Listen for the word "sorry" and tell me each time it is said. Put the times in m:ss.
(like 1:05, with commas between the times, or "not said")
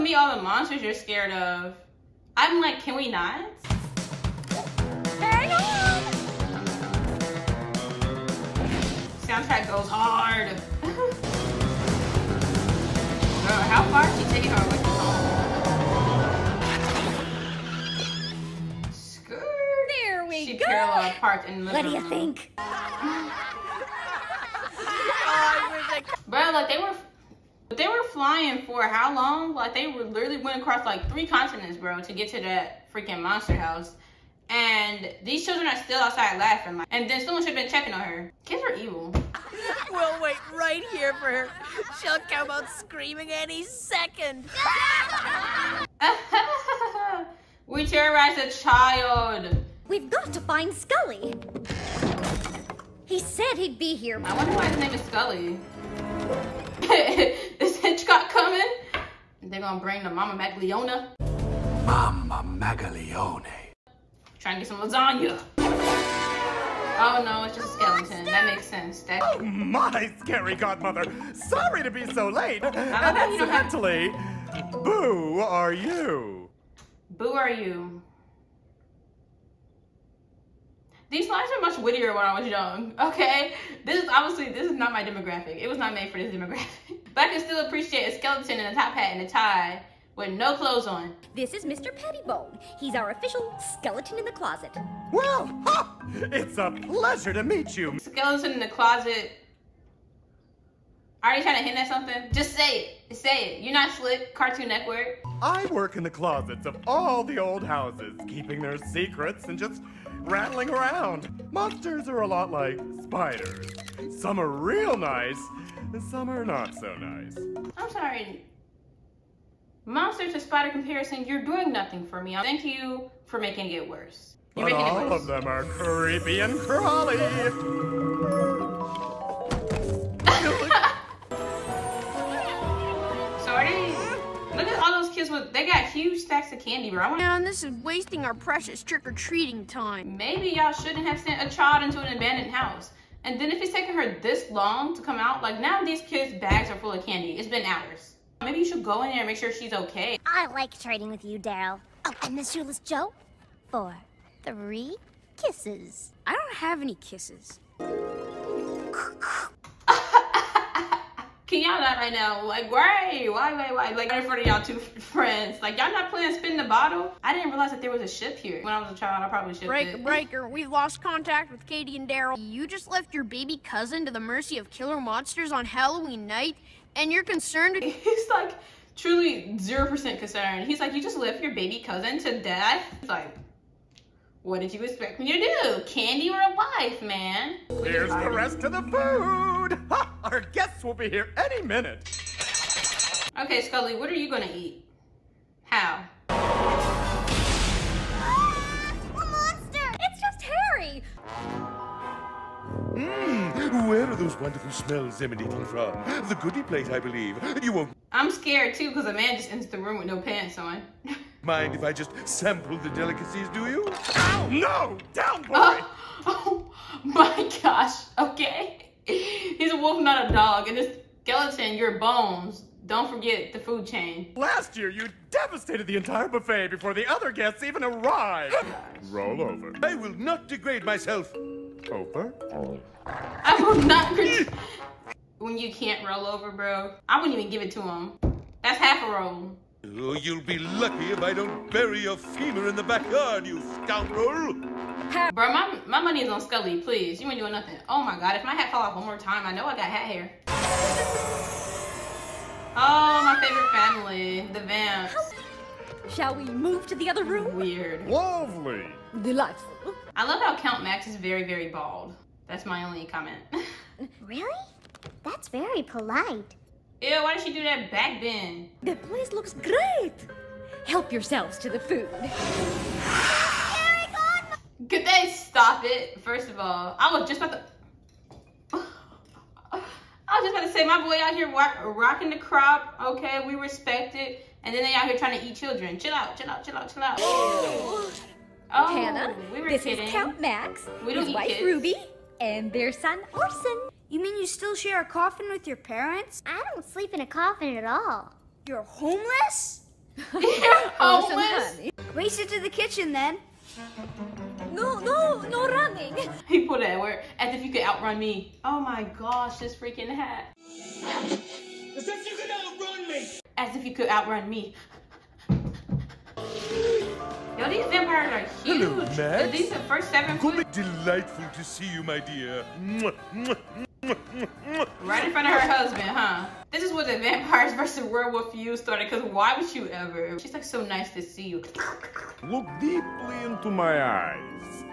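1:11, 1:57.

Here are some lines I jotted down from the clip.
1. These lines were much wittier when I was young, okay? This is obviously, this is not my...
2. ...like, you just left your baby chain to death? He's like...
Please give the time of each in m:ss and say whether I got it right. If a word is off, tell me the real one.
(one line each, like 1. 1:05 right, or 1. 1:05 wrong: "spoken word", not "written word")
1. 1:21 right
2. 3:00 wrong: "cousin", not "chain".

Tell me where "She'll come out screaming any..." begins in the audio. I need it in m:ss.
0:42.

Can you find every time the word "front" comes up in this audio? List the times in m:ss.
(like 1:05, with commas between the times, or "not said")
2:44, 5:25.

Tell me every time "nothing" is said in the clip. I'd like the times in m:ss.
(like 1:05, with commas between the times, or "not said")
2:01, 4:07.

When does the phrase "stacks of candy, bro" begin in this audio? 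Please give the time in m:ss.
2:16.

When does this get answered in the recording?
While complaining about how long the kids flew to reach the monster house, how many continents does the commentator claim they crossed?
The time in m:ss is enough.
0:31.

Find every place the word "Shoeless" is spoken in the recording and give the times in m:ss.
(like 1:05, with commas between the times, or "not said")
2:32.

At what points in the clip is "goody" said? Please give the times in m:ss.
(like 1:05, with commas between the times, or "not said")
3:26.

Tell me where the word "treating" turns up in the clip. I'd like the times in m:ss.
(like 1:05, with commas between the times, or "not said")
2:18.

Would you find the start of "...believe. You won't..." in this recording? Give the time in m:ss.
3:27.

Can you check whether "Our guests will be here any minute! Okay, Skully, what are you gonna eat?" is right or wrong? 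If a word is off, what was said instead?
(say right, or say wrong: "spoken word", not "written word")
right.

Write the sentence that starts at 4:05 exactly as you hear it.
Bro, my, my money is on Skully, please.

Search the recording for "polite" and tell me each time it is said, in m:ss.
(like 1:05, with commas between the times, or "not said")
4:25.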